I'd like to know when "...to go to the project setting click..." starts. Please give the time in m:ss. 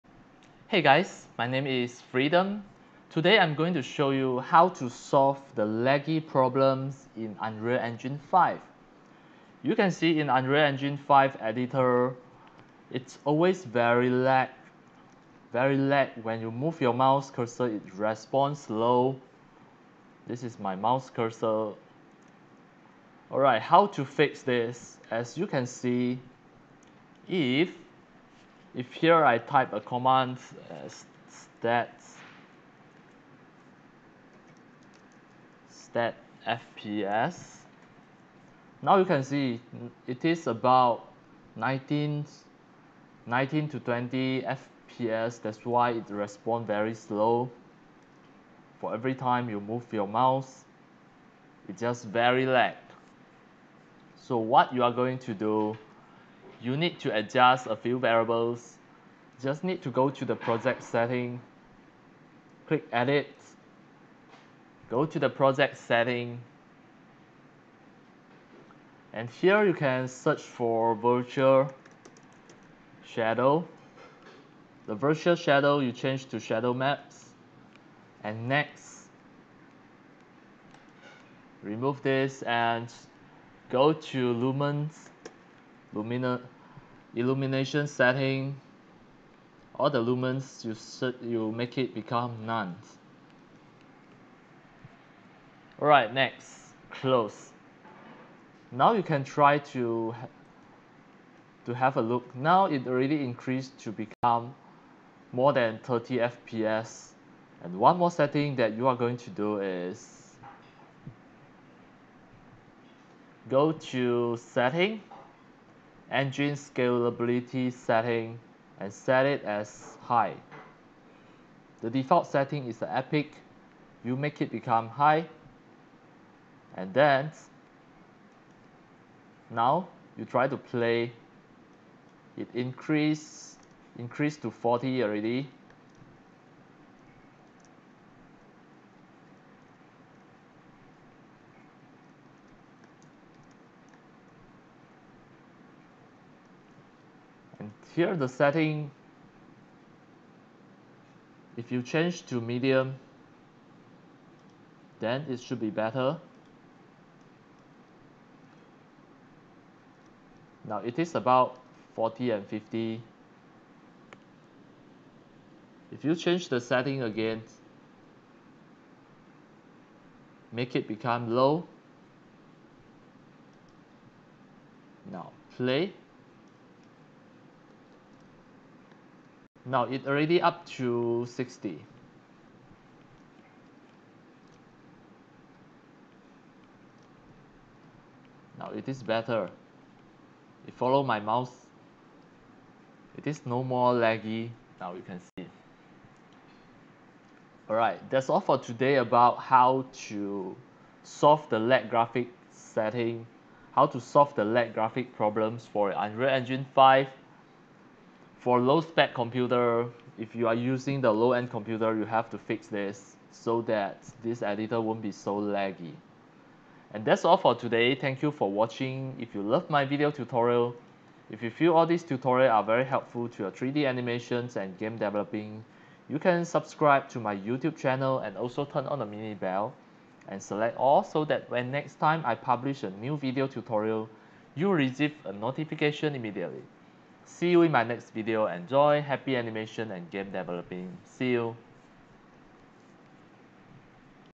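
0:59.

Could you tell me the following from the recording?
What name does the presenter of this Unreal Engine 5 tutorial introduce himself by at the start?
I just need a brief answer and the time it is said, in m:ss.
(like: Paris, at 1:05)
Freedom, at 0:02.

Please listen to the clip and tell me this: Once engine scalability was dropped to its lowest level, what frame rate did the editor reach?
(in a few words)
60.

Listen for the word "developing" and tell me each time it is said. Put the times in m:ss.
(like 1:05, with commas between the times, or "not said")
3:44, 4:00.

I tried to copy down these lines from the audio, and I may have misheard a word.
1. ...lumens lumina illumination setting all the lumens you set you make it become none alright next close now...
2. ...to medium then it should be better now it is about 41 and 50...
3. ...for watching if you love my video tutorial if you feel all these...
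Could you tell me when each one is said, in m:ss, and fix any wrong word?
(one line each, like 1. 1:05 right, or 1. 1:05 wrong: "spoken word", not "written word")
1. 1:24 right
2. 2:32 wrong: "40", not "41"
3. 3:38 right.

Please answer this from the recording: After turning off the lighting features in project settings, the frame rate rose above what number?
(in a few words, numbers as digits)
30.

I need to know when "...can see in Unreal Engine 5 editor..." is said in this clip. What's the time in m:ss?
0:09.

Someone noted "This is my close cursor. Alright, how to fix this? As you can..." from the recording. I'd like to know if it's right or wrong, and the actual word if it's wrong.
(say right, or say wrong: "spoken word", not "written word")
wrong: "mouse", not "close".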